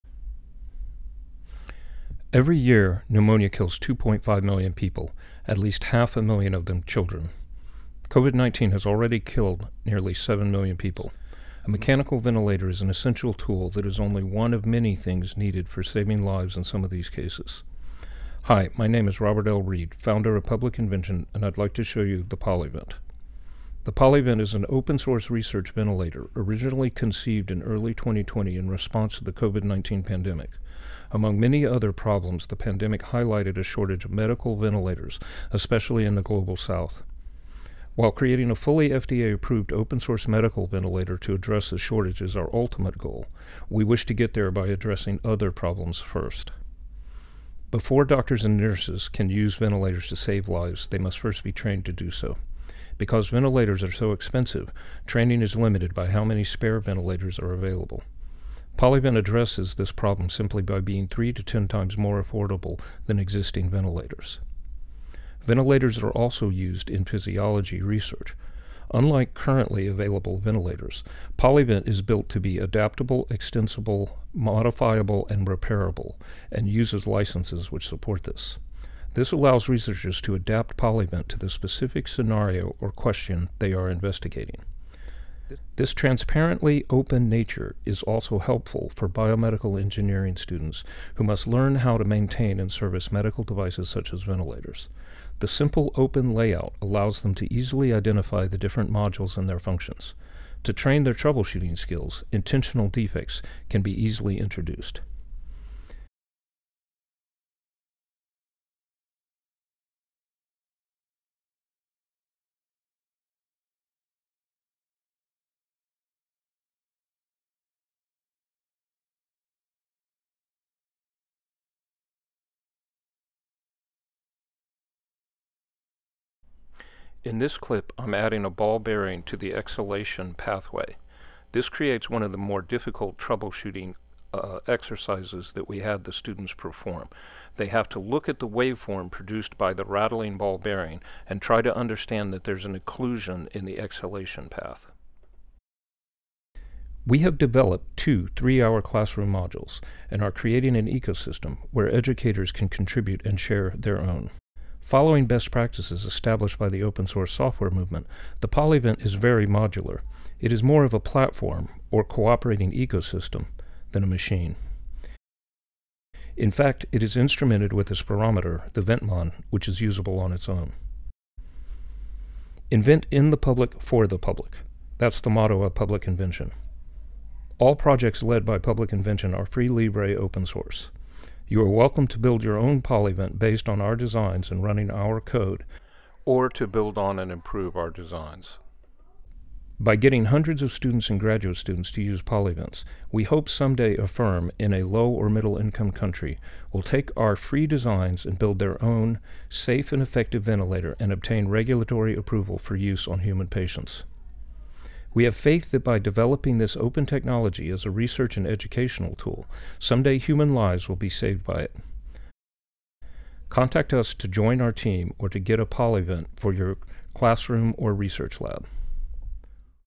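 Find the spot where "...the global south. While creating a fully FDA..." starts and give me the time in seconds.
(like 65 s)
36 s.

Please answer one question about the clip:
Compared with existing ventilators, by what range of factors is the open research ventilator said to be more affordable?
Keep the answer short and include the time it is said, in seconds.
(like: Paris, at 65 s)
3 to 10 times, at 61 s.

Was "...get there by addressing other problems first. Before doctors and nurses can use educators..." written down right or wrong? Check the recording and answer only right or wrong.
wrong.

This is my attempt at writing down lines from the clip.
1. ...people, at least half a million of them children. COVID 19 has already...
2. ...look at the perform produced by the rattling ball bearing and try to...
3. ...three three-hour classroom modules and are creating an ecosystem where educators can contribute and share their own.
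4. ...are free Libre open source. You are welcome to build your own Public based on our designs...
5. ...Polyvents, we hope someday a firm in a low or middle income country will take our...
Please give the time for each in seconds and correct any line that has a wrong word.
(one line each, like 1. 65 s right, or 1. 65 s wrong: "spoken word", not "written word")
1. 4 s right
2. 137 s wrong: "waveform", not "perform"
3. 147 s wrong: "two", not "three"
4. 179 s wrong: "PolyVent", not "Public"
5. 192 s right.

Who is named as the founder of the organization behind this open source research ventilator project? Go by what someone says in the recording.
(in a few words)
Robert L. Reed.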